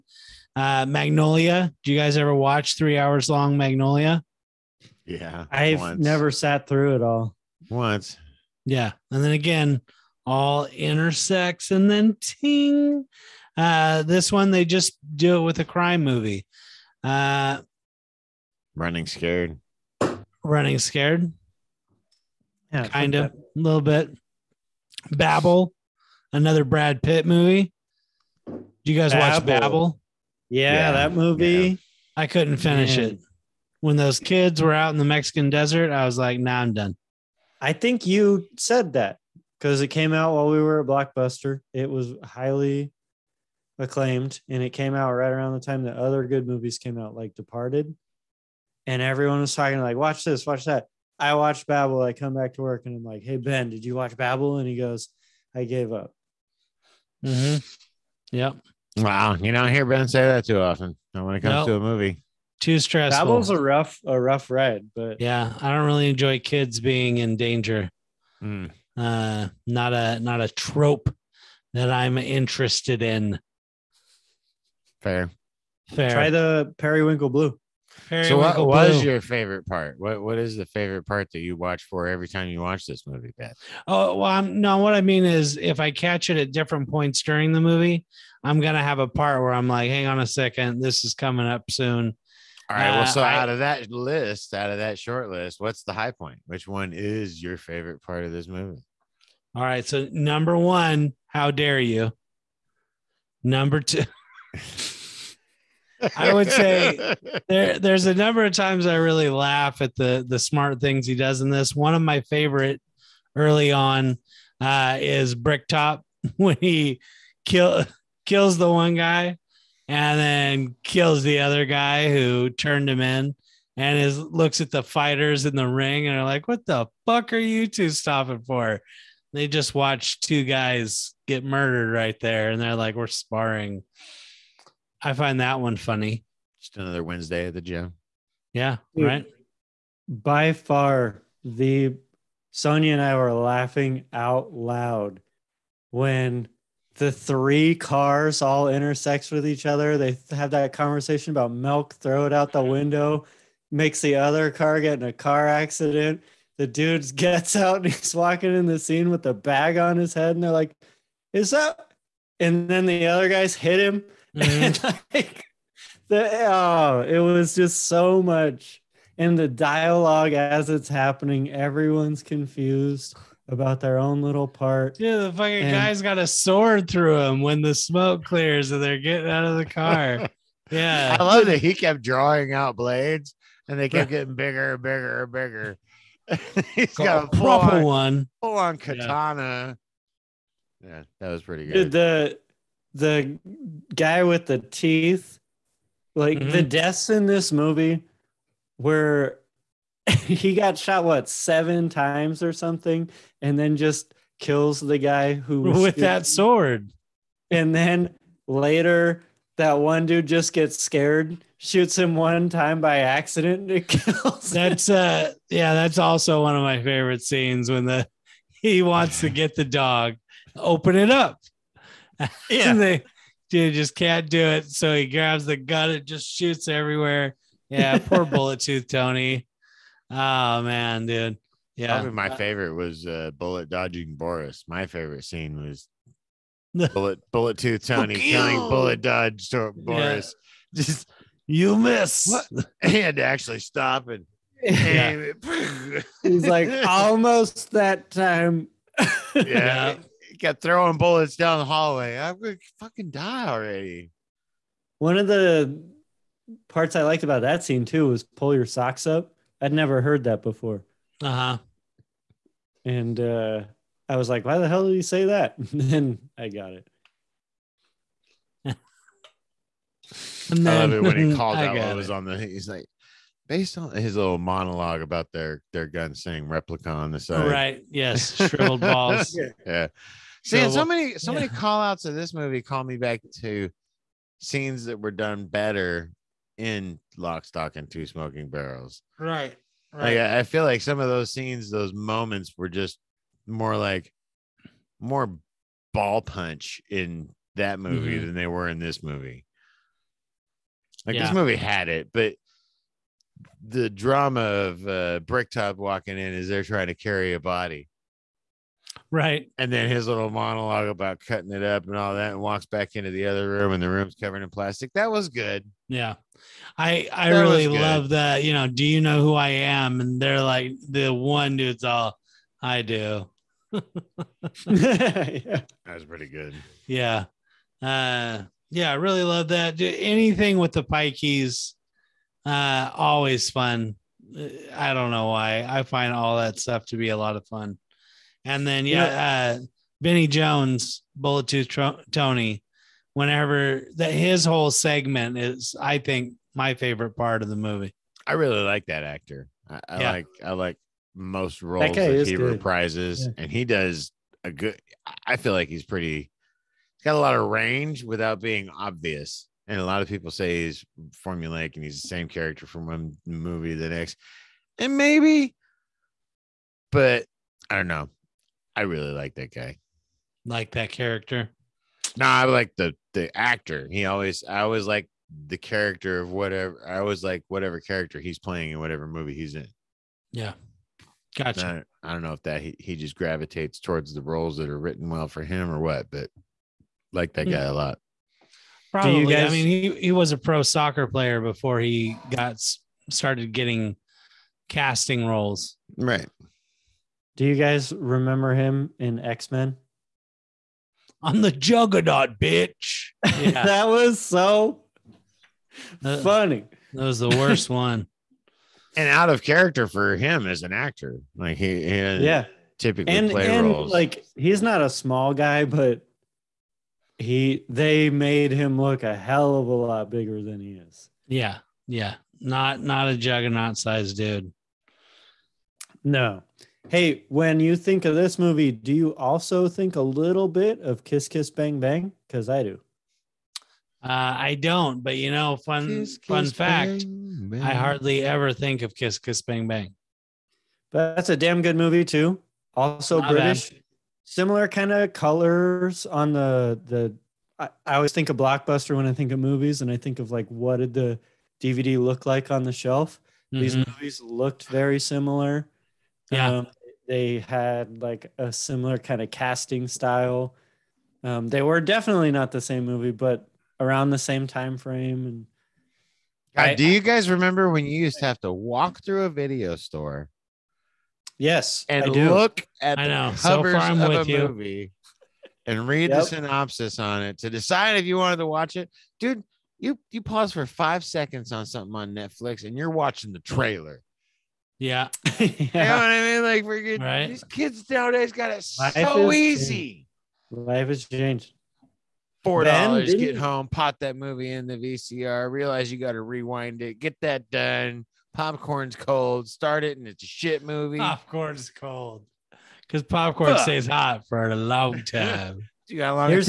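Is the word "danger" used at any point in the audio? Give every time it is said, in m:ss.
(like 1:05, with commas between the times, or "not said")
1:07.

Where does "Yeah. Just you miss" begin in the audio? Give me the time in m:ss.
4:00.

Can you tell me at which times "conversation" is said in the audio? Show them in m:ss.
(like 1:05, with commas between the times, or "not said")
2:30.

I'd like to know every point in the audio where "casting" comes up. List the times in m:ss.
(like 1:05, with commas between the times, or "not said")
6:34, 7:39.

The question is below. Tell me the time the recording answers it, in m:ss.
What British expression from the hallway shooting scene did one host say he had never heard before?
4:18.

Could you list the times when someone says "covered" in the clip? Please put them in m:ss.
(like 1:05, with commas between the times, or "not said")
5:14.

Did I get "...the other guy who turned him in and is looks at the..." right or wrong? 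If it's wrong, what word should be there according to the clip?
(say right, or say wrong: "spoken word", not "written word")
right.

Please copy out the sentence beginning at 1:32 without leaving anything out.
Well, uh, so I, out of that list, out of that short list, what's the high point?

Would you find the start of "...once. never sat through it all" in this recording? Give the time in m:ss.
0:05.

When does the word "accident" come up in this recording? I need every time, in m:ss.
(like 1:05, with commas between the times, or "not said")
2:35, 3:32.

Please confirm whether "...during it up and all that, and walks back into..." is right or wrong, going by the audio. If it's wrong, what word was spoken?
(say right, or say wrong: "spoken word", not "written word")
wrong: "cutting", not "during".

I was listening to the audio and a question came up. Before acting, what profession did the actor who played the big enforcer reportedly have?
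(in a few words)
Pro soccer player.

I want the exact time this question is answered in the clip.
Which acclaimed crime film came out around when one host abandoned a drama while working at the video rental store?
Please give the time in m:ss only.
0:47.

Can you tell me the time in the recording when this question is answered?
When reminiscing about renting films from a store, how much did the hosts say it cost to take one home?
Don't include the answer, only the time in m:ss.
8:12.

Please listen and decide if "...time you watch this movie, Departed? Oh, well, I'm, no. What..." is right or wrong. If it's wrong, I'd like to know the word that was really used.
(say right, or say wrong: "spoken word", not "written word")
wrong: "Pat", not "Departed".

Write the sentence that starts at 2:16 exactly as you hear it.
Just another Wednesday at the gym.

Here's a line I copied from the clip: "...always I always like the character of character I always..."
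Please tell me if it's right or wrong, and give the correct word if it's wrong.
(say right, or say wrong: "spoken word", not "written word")
wrong: "whatever", not "character".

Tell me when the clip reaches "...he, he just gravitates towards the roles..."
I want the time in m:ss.
6:22.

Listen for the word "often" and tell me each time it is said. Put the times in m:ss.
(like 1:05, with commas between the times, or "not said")
1:00.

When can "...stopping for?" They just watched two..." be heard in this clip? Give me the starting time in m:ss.
2:07.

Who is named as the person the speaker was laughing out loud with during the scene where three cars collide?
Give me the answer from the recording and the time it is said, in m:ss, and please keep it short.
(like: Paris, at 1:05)
Sonia, at 2:22.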